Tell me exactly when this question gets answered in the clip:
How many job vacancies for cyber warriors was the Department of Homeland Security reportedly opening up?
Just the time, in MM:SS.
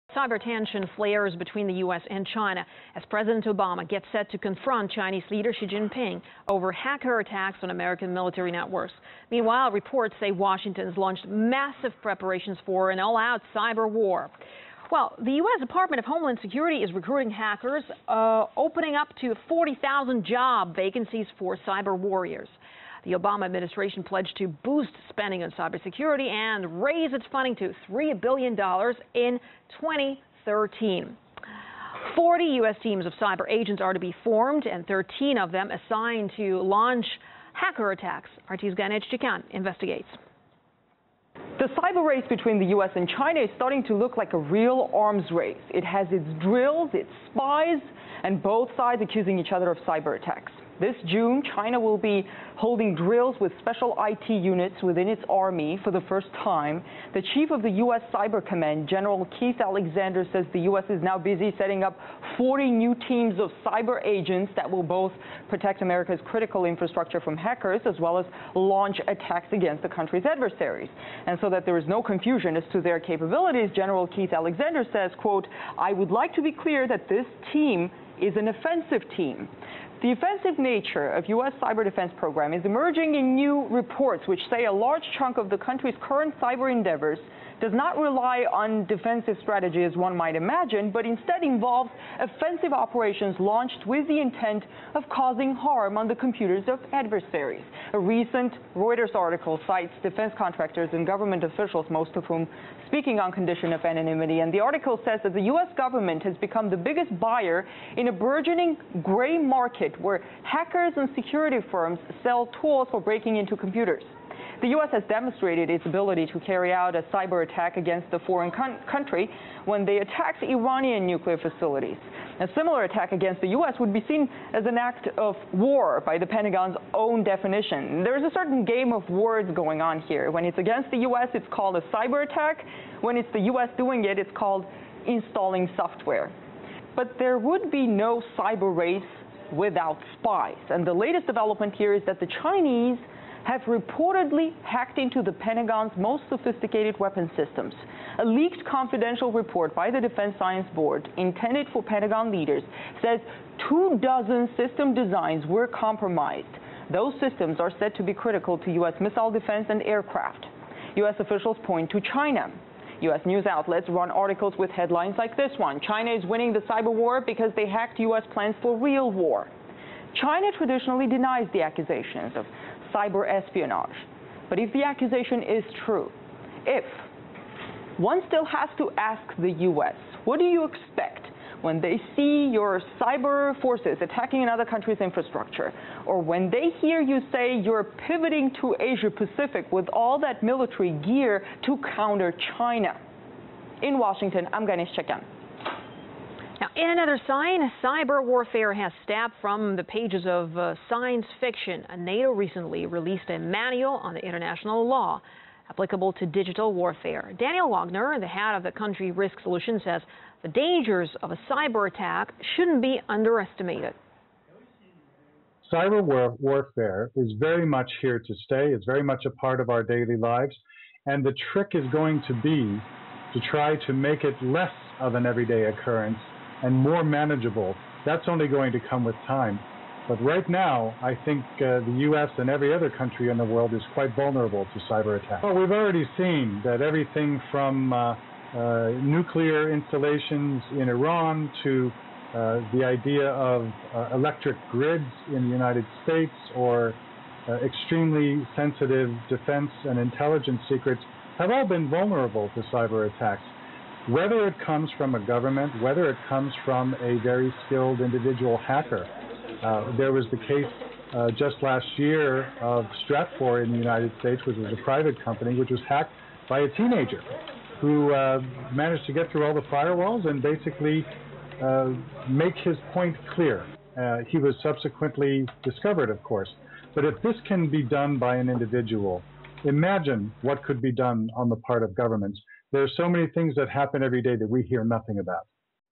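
00:19.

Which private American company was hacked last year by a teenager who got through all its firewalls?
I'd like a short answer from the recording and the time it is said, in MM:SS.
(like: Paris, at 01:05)
Stratfor, at 04:23.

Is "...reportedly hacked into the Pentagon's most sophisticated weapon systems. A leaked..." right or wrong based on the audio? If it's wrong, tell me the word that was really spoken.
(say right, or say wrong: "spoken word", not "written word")
right.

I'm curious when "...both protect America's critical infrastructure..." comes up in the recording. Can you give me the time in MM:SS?
01:04.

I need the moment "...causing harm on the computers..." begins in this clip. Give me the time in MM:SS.
01:35.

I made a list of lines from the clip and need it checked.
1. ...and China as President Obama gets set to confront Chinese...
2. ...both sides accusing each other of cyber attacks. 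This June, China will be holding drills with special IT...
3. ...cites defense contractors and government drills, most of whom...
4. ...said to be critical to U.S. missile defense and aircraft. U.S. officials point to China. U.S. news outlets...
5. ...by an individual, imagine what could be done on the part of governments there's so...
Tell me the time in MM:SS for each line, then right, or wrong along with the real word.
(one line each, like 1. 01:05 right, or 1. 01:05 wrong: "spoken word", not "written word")
1. 00:02 right
2. 00:48 right
3. 01:39 wrong: "officials", not "drills"
4. 02:37 right
5. 04:38 right.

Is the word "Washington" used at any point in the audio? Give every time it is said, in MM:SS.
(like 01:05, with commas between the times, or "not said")
00:10, 03:13.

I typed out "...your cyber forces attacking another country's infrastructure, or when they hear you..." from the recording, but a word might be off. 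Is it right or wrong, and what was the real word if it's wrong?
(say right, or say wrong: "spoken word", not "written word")
right.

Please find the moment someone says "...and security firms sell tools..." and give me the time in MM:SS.
01:50.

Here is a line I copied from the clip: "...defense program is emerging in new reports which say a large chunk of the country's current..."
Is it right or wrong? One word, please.
right.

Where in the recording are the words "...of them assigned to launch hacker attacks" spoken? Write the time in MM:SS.
00:35.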